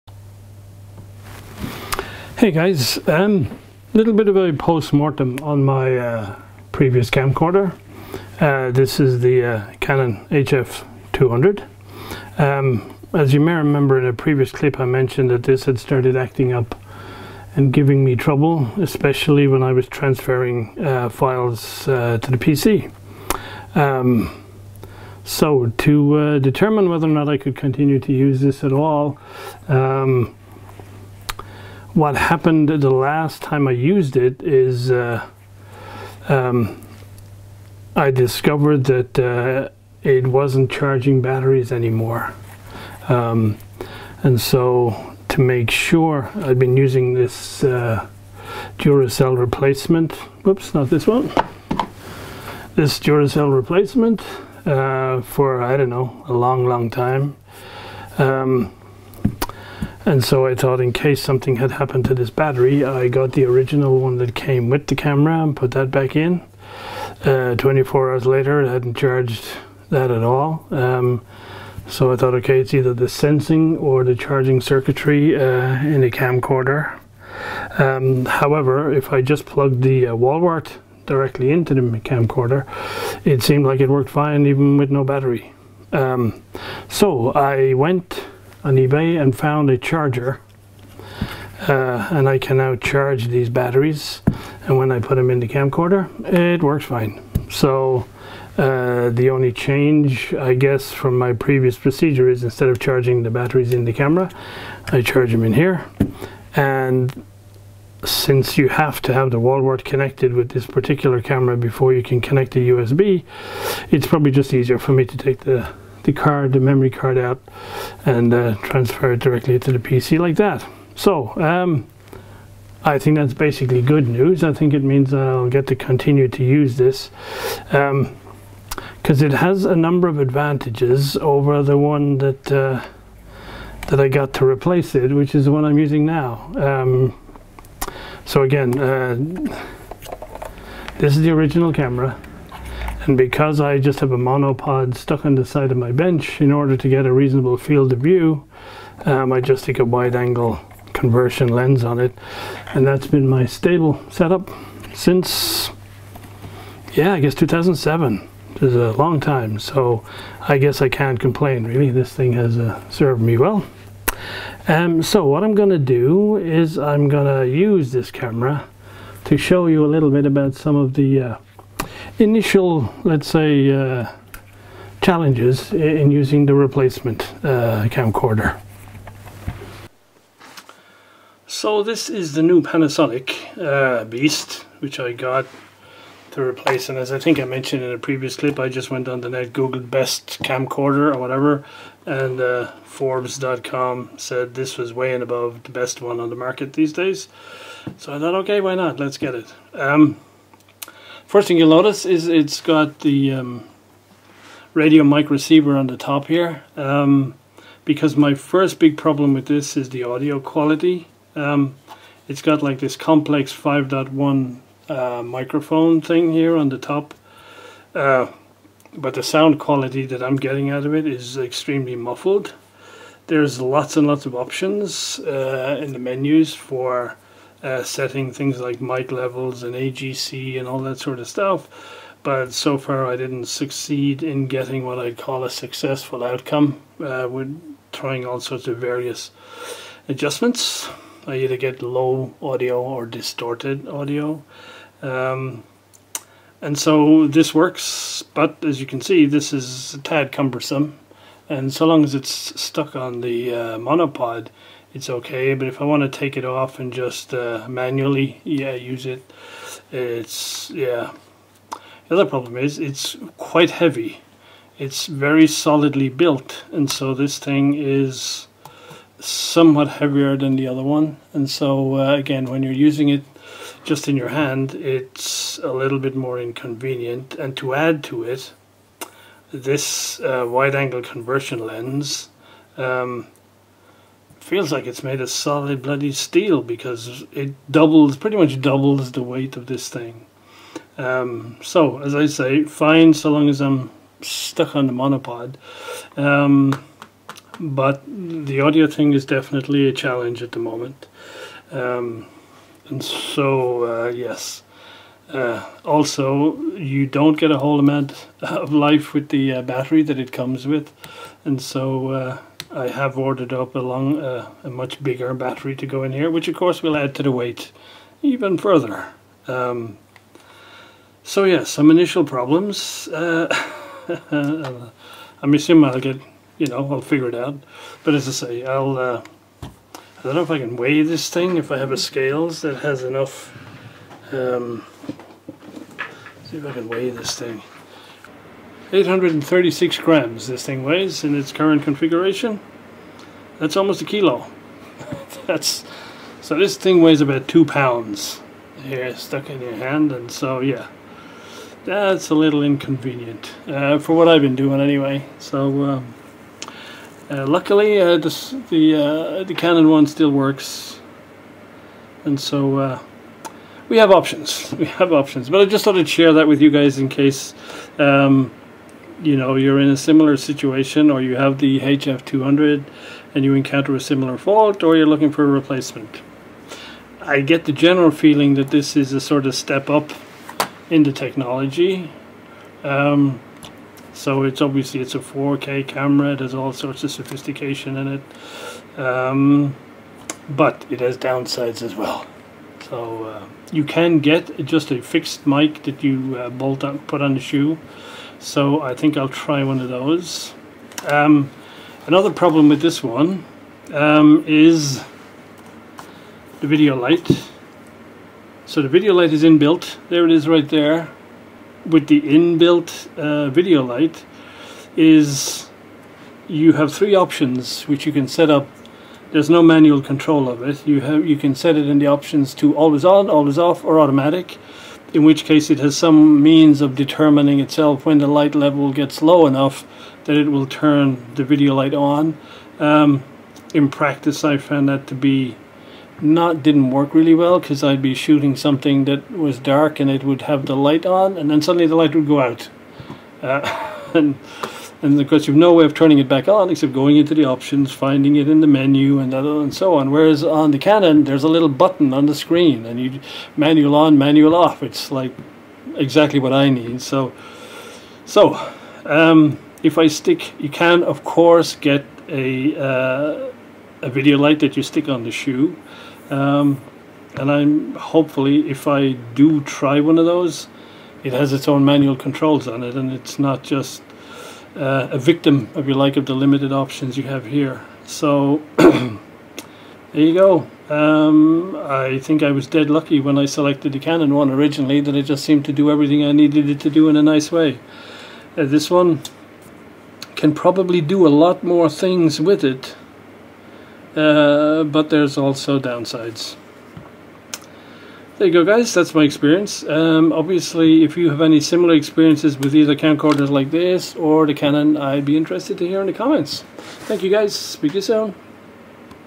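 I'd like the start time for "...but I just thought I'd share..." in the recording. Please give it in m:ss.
6:05.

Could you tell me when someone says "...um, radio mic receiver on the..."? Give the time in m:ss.
3:23.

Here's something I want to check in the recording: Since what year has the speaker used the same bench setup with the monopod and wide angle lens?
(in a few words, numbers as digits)
2007.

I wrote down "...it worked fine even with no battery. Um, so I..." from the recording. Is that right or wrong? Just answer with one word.
right.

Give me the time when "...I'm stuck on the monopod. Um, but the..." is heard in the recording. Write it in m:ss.
4:53.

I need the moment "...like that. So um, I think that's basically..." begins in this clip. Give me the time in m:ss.
2:00.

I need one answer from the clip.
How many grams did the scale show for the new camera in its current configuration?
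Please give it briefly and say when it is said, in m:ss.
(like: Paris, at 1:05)
836 grams, at 5:38.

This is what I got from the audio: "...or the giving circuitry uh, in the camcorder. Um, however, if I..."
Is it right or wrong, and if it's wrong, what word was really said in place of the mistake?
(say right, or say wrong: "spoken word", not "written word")
wrong: "charging", not "giving".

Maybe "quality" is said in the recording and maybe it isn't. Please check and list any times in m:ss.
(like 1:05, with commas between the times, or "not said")
3:30, 3:39.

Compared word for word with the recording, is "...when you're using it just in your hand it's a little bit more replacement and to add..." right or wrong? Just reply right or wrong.
wrong.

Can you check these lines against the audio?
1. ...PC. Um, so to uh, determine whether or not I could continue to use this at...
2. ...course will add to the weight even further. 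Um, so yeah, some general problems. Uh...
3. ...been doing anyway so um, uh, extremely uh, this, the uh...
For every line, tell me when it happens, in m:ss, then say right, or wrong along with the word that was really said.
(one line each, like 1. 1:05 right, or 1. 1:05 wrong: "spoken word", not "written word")
1. 0:22 right
2. 5:16 wrong: "initial", not "general"
3. 5:54 wrong: "luckily", not "extremely".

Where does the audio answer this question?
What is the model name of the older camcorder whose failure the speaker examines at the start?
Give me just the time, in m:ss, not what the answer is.
0:09.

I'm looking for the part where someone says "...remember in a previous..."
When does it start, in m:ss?
0:13.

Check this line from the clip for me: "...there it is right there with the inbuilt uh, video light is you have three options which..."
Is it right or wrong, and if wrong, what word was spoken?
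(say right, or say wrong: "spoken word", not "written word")
right.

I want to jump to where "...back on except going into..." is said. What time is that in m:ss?
7:26.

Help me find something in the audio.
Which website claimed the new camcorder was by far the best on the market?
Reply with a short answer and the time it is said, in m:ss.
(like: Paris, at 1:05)
Forbes.com, at 3:12.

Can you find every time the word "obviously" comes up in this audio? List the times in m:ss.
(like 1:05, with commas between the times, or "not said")
6:24, 8:20.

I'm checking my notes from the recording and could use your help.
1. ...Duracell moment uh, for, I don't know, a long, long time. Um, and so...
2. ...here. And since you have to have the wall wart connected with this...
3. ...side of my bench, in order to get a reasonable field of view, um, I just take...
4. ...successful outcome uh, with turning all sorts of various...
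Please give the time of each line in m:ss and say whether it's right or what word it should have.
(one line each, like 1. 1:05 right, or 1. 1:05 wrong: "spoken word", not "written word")
1. 0:52 wrong: "replacement", not "moment"
2. 1:45 right
3. 2:25 right
4. 3:55 wrong: "trying", not "turning".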